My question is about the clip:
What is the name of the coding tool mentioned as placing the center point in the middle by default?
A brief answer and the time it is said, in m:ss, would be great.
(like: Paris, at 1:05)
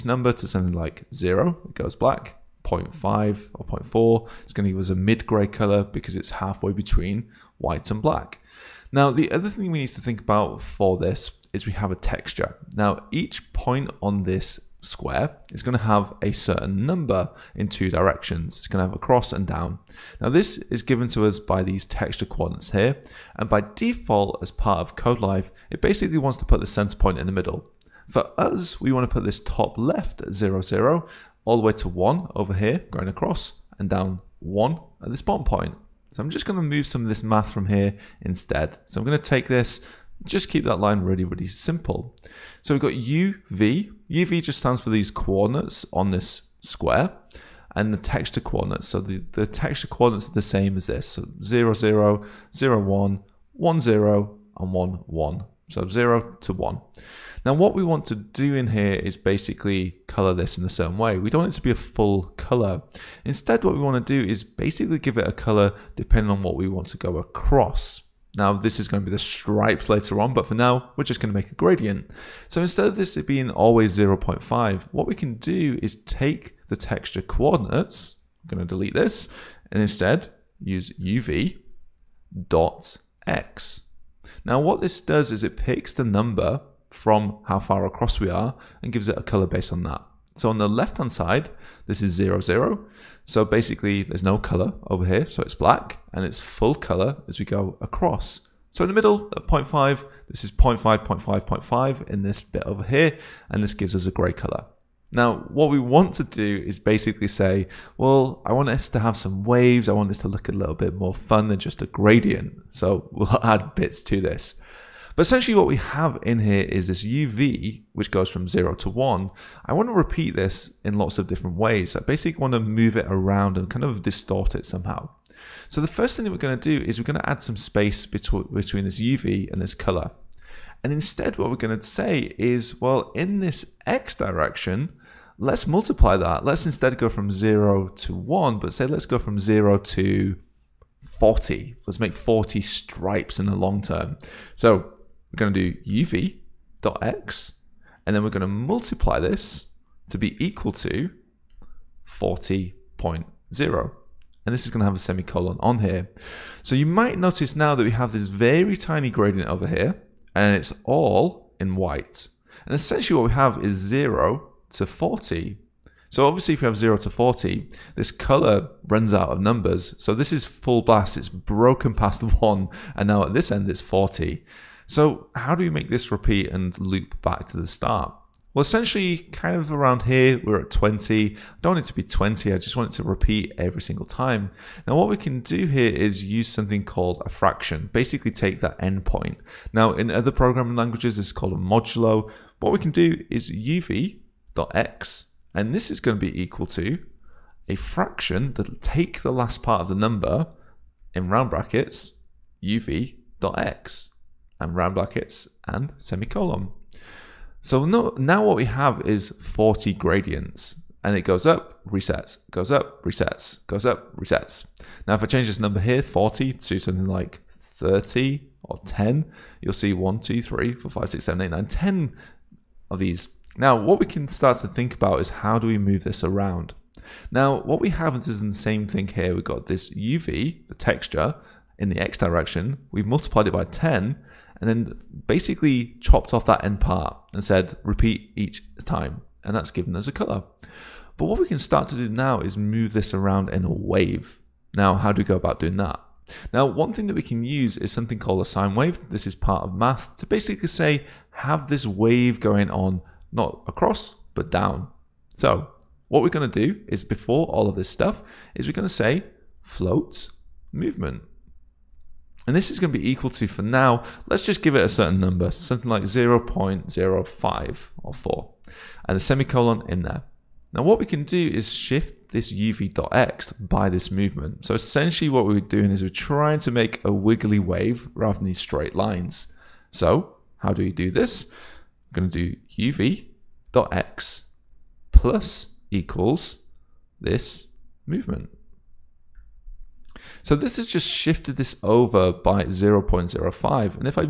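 KodeLife, at 0:24.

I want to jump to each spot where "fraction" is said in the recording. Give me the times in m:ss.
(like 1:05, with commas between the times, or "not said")
3:07, 3:17.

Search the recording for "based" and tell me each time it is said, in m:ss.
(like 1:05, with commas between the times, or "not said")
1:29.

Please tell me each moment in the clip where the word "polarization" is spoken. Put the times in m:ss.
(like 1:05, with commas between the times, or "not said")
not said.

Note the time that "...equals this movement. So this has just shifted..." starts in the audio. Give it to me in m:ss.
4:45.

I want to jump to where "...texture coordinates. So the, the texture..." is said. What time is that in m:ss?
0:47.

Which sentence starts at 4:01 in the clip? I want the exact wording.
But what we can start to do now is move this around in a wave.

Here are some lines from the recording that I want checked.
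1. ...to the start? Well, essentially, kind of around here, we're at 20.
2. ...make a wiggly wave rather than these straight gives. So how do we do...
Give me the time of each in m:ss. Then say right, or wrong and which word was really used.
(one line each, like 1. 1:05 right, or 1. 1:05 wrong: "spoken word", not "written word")
1. 2:57 right
2. 4:36 wrong: "lines", not "gives".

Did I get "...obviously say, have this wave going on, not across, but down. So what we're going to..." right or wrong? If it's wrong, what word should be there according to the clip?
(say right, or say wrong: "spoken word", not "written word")
wrong: "basically", not "obviously".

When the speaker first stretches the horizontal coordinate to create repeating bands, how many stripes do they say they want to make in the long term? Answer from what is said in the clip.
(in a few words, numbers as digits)
40.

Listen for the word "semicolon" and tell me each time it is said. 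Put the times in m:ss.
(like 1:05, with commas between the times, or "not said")
2:34, 3:25, 4:29.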